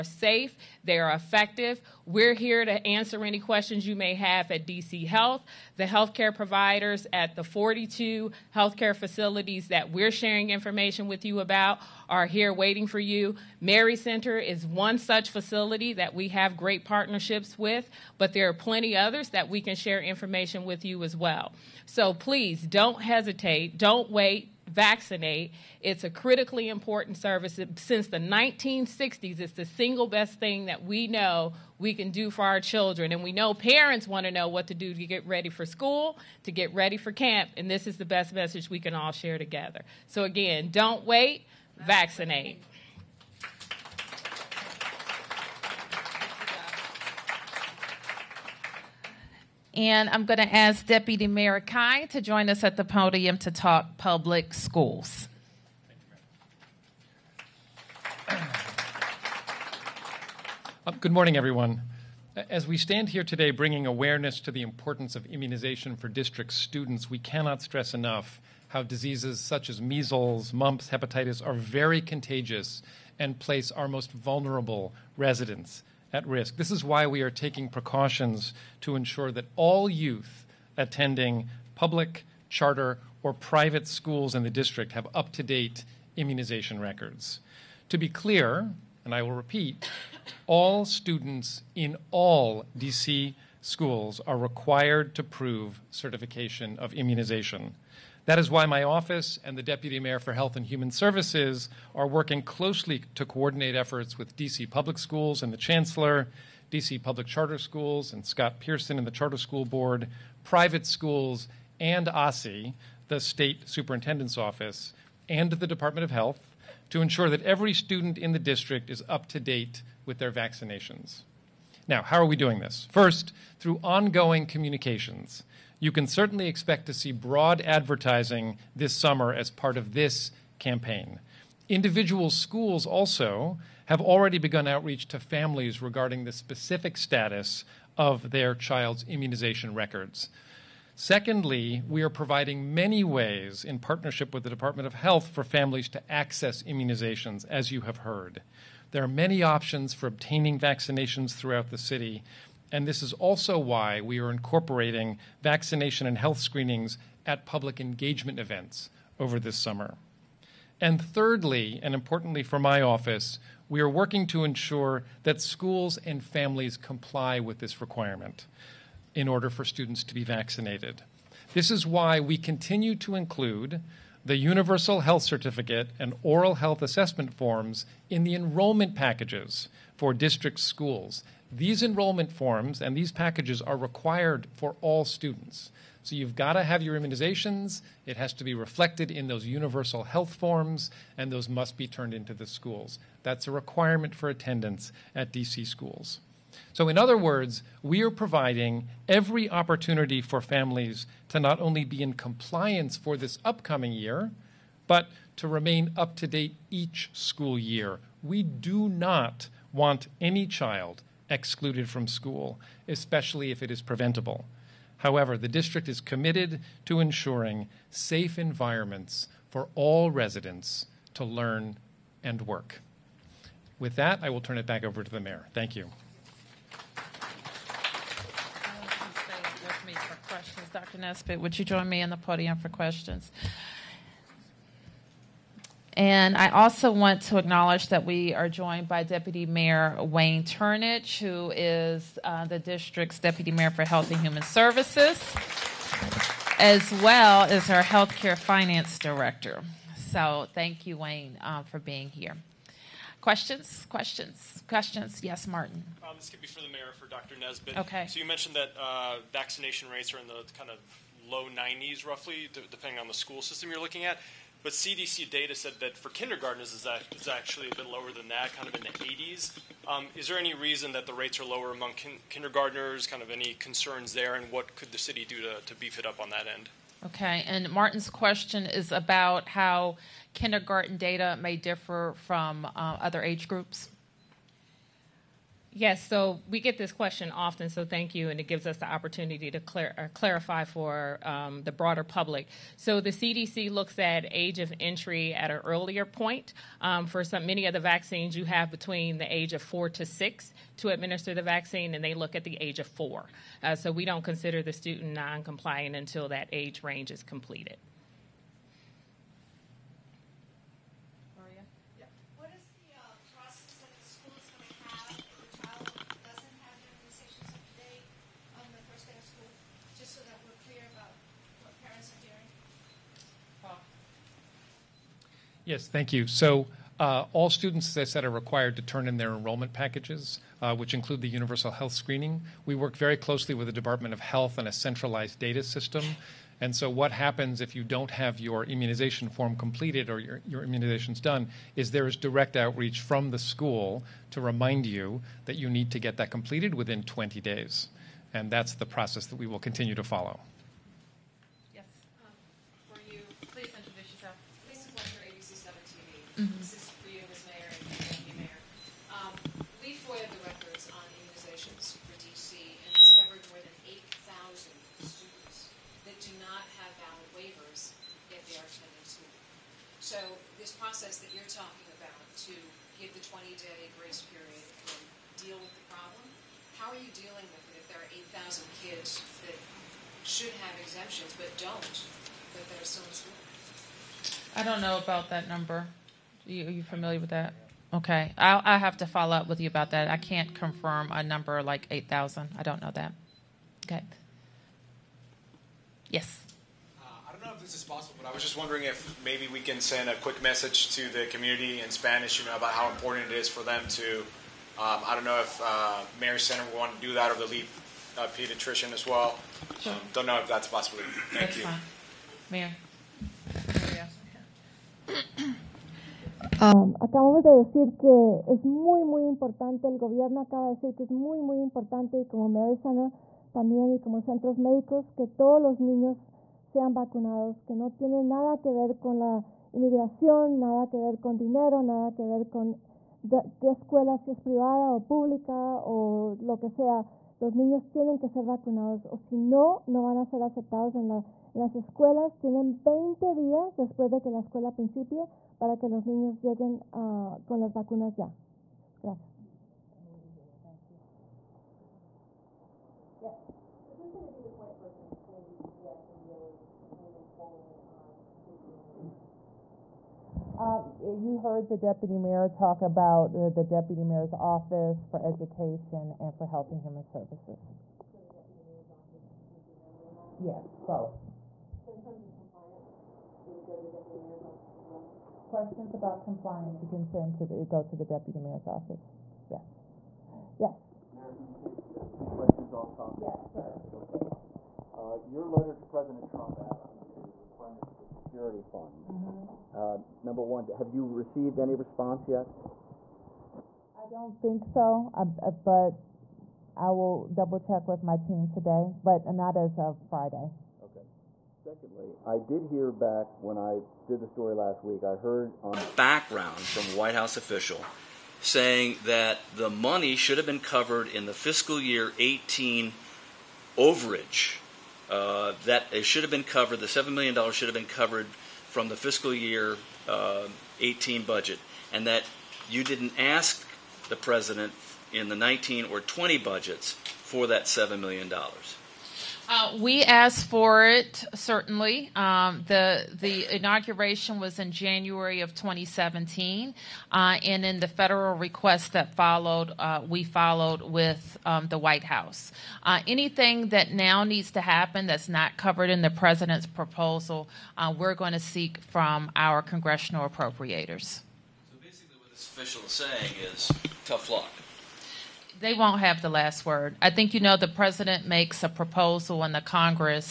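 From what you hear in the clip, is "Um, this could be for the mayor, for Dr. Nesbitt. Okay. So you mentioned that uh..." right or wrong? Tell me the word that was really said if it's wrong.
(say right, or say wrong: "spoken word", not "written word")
right.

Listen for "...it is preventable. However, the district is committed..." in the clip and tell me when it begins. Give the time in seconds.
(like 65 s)
213 s.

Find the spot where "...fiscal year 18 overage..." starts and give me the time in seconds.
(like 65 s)
511 s.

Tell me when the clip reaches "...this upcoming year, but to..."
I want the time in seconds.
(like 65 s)
203 s.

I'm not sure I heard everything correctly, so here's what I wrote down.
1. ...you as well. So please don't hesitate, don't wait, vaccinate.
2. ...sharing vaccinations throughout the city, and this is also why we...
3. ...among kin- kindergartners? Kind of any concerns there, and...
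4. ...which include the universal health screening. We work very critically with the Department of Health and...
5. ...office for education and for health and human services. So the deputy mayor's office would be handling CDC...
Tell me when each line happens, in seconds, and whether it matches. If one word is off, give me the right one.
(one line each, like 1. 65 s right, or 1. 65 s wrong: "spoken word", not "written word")
1. 20 s right
2. 150 s wrong: "obtaining", not "sharing"
3. 271 s right
4. 330 s wrong: "closely", not "critically"
5. 464 s wrong: "Yes", not "CDC".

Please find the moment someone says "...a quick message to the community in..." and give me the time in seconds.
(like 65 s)
400 s.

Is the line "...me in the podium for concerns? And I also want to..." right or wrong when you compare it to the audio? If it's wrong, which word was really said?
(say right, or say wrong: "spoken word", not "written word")
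wrong: "questions", not "concerns".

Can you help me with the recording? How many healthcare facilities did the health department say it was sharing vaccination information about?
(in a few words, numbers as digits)
42.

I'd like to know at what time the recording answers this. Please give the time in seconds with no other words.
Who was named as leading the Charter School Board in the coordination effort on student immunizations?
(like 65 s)
108 s.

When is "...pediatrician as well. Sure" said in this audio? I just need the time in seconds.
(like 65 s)
408 s.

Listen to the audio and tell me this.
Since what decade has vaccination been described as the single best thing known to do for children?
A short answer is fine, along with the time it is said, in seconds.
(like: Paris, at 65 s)
1960s, at 28 s.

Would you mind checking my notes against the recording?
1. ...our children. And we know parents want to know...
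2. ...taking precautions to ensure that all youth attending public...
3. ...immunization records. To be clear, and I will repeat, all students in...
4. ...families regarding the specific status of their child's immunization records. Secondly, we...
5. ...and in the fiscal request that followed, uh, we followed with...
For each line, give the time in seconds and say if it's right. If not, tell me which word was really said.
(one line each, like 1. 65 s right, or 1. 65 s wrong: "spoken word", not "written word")
1. 32 s right
2. 77 s right
3. 86 s right
4. 135 s right
5. 537 s wrong: "federal", not "fiscal".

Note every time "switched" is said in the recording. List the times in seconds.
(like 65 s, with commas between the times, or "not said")
not said.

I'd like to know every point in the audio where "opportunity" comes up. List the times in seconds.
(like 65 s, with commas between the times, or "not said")
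199 s, 288 s.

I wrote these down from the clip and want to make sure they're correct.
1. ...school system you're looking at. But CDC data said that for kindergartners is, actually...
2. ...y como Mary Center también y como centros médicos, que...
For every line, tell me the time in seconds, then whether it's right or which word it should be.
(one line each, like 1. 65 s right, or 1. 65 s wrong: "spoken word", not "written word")
1. 263 s right
2. 422 s right.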